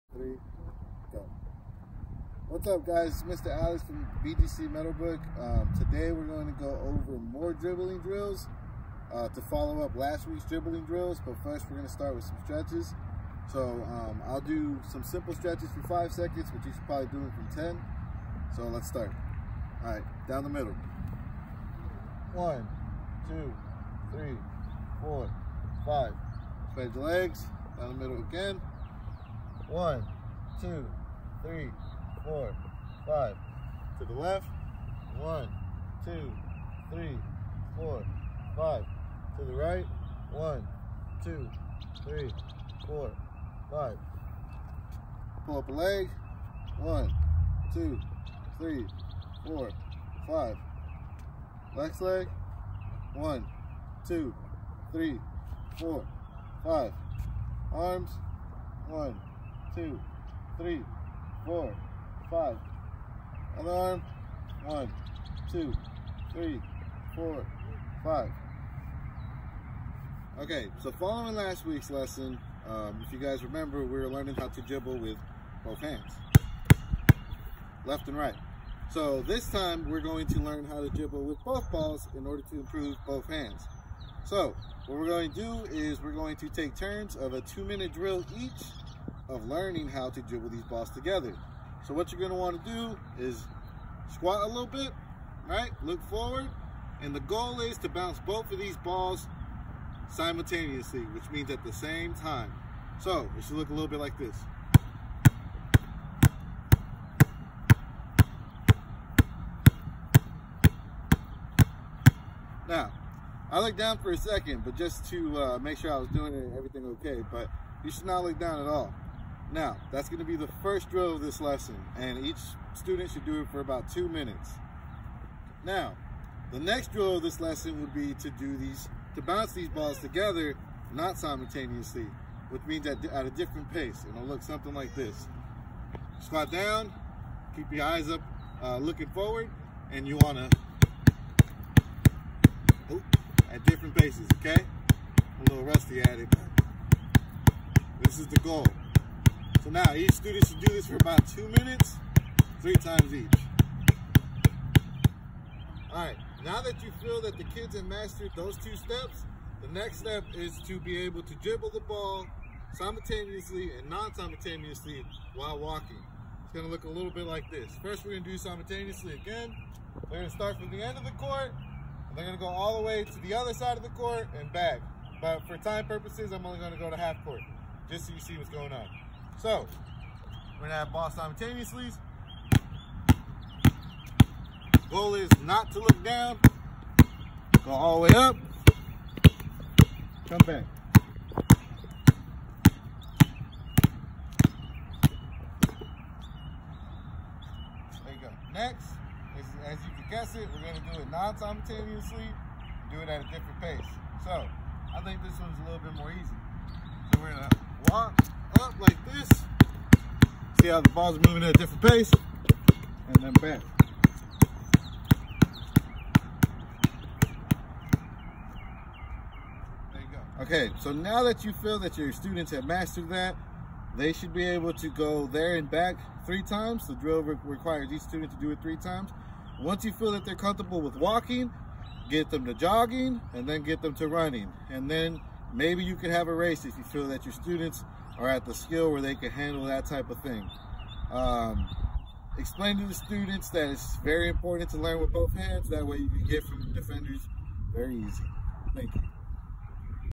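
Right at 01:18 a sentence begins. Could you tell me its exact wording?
So this time we're going to learn how to dribble with both balls in order to improve both hands.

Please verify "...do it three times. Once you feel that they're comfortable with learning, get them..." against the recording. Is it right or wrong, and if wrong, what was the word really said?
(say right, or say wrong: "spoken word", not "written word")
wrong: "walking", not "learning".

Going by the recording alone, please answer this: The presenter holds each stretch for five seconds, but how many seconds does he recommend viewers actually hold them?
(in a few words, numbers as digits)
10.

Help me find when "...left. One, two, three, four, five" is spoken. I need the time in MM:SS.
00:34.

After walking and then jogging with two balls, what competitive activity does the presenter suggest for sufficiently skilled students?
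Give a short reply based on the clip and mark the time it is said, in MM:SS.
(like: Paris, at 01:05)
a race, at 03:56.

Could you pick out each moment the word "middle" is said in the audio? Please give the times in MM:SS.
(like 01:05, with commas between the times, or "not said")
00:20, 00:28.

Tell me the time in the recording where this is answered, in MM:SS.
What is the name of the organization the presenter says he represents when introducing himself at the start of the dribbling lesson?
00:04.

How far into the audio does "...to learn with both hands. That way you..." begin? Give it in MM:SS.
04:04.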